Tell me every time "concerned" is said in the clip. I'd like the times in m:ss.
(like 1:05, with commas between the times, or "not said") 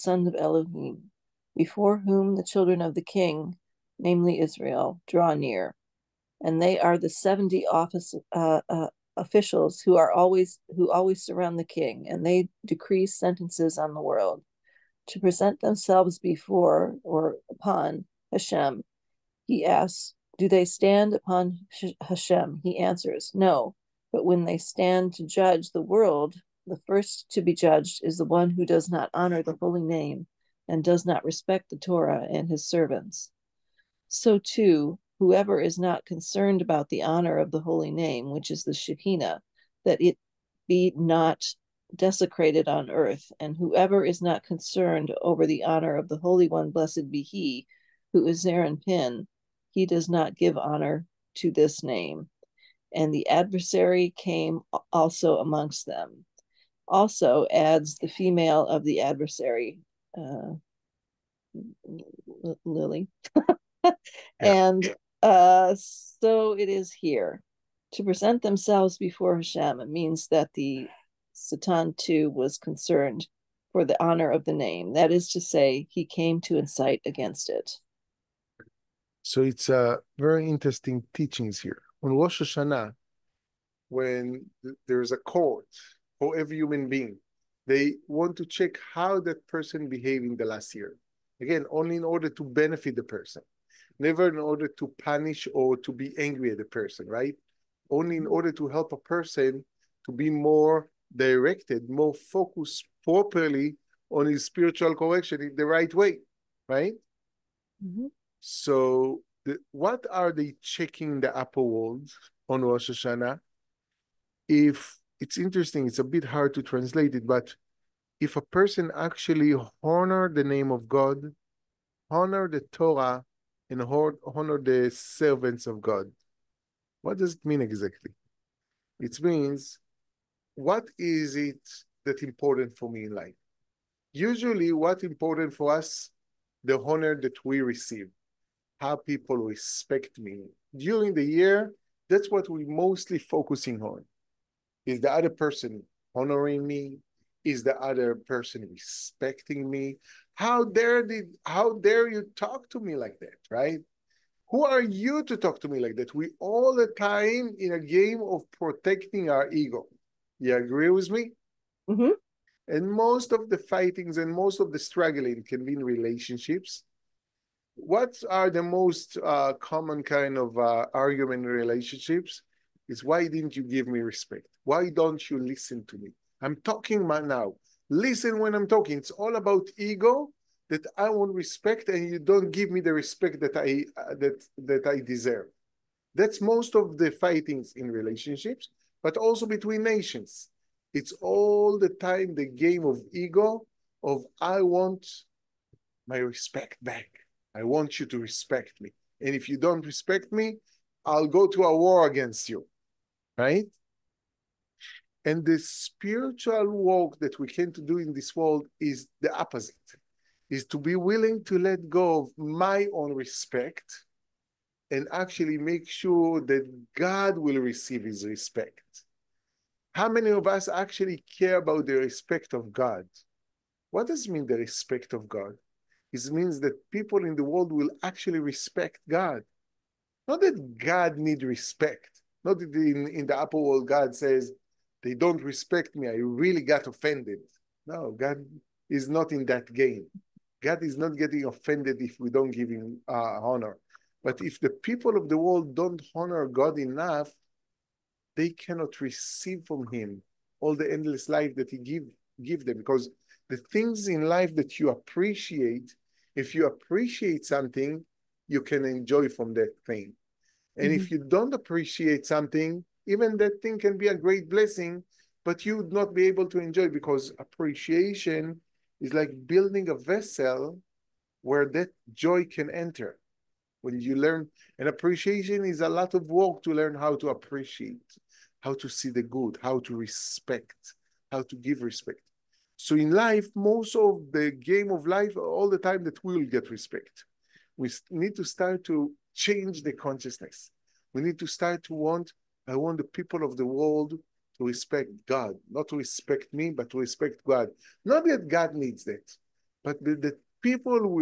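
0:36, 0:44, 1:12.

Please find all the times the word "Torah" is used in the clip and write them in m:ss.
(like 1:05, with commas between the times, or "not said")
0:31, 2:02.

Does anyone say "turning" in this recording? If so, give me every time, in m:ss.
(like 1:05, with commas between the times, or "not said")
not said.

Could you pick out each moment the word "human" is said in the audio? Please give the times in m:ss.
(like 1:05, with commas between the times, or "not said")
1:26.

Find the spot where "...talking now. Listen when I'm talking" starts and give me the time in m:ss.
2:56.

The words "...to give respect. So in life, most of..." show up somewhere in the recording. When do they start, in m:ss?
4:41.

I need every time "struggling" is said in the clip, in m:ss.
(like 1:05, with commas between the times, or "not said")
2:44.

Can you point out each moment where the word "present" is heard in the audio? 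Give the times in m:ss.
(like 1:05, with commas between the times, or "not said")
0:15, 1:08.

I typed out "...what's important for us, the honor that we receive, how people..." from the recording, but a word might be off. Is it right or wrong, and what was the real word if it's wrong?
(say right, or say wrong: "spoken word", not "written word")
right.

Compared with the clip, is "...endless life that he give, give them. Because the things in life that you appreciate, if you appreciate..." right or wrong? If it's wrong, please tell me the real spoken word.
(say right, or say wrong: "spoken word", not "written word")
right.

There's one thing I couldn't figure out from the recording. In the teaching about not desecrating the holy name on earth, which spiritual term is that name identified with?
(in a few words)
Shekinah.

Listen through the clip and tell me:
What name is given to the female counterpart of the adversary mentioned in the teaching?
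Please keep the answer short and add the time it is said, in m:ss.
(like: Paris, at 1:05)
Lily, at 1:02.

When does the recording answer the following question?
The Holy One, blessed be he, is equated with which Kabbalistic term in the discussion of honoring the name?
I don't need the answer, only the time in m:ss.
0:48.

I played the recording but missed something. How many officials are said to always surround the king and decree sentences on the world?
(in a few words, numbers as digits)
70.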